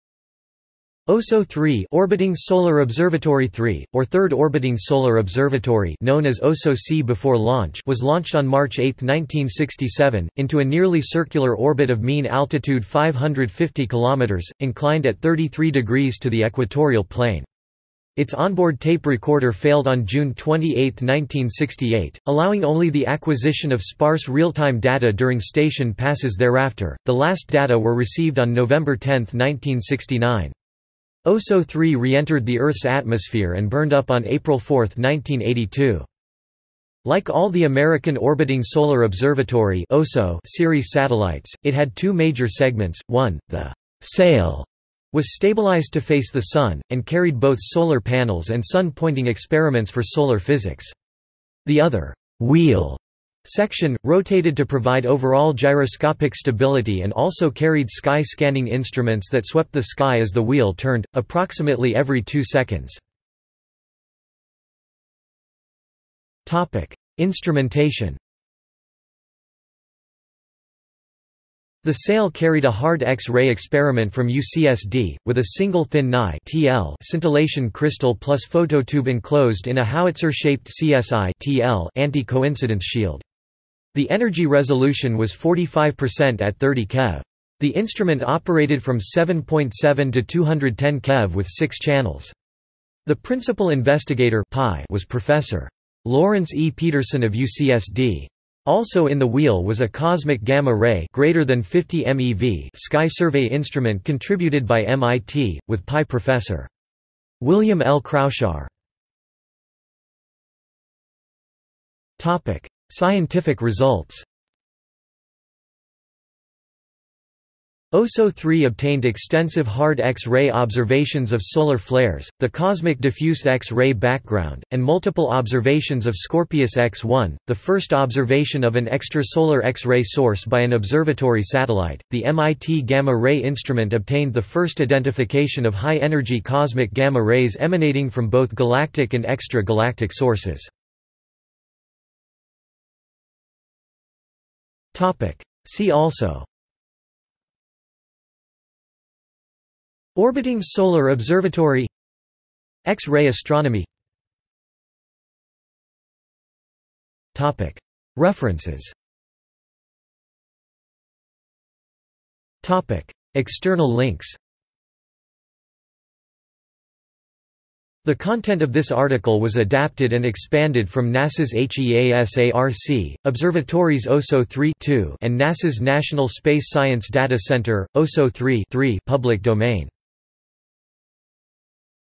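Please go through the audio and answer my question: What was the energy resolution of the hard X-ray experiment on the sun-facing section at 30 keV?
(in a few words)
45%.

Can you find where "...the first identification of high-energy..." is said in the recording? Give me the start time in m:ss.
2:14.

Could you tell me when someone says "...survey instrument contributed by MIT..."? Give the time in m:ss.
1:43.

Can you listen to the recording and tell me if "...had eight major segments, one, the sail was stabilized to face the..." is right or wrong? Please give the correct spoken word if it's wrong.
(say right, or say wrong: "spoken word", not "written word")
wrong: "two", not "eight".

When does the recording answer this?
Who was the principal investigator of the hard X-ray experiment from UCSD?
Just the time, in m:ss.
1:36.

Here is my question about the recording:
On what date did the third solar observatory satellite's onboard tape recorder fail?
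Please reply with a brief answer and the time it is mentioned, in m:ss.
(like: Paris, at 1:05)
June 28, 1968, at 0:20.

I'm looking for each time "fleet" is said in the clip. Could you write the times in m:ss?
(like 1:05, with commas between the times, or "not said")
not said.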